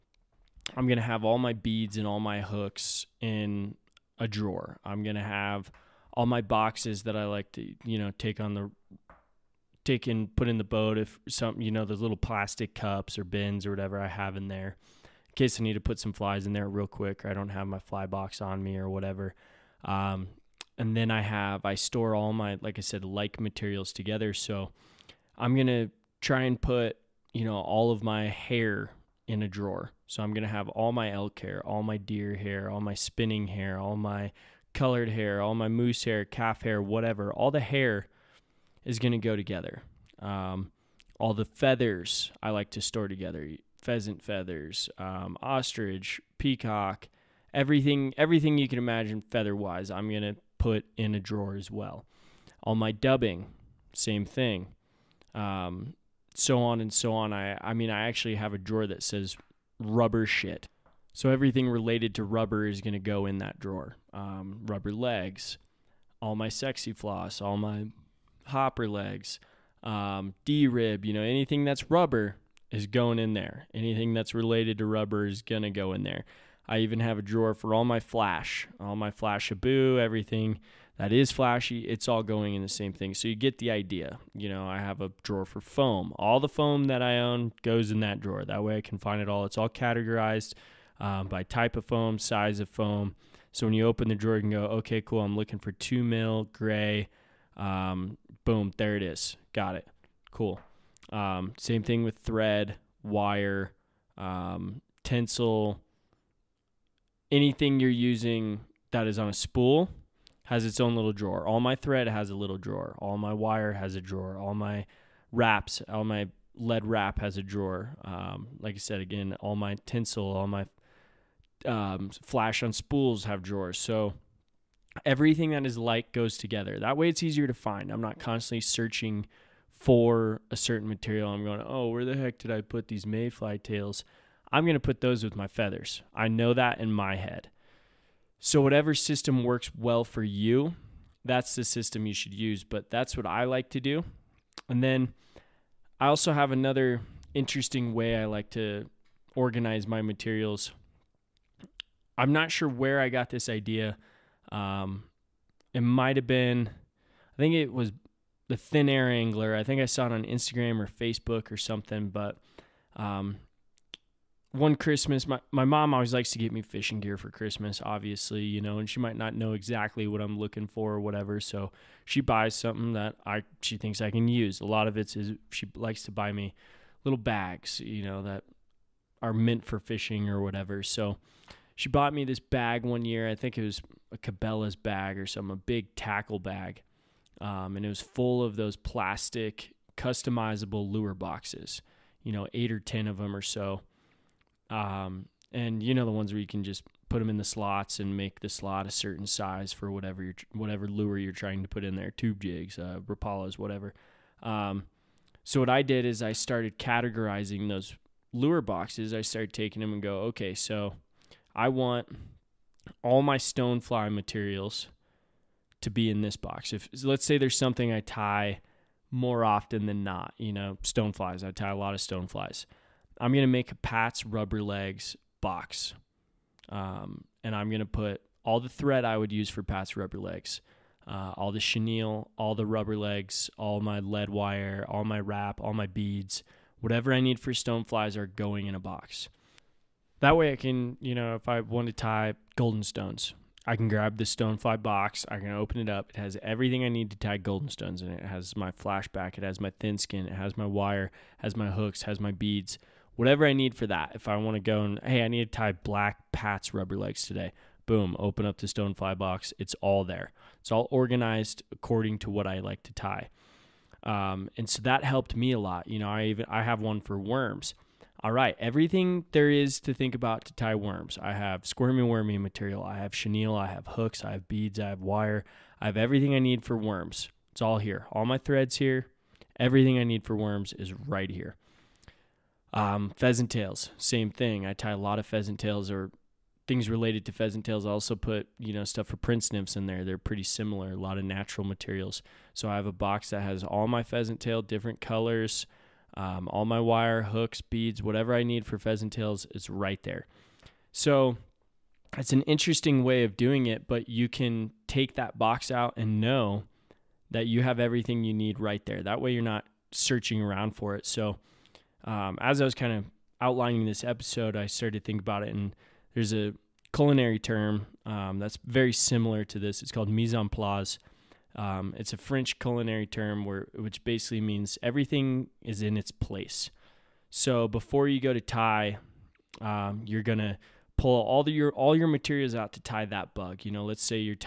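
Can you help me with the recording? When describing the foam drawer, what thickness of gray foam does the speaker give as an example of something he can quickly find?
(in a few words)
2 mil.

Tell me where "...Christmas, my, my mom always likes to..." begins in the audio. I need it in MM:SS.
02:44.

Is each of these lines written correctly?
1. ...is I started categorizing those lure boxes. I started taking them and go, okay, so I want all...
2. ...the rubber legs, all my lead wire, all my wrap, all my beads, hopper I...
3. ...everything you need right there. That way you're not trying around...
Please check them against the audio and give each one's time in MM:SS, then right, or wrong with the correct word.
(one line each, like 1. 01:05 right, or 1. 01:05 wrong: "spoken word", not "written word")
1. 03:26 right
2. 03:52 wrong: "whatever", not "hopper"
3. 05:07 wrong: "searching", not "trying".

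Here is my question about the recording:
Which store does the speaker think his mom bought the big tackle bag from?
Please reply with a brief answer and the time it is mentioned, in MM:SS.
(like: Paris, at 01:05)
Cabela's, at 03:04.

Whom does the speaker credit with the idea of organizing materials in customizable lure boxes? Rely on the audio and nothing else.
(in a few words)
Thin Air Angler.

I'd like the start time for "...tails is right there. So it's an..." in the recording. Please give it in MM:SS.
04:59.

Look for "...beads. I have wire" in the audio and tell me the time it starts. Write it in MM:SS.
04:34.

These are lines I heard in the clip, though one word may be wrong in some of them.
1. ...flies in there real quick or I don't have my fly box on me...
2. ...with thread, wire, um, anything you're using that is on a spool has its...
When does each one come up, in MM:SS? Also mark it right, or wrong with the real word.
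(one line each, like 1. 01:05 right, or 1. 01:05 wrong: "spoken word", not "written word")
1. 00:16 right
2. 01:42 right.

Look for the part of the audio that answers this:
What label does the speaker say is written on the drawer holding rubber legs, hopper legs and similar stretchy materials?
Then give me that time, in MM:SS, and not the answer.
00:59.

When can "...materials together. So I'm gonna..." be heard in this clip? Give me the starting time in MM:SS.
00:23.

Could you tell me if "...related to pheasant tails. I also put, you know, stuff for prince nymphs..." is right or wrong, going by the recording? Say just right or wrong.
right.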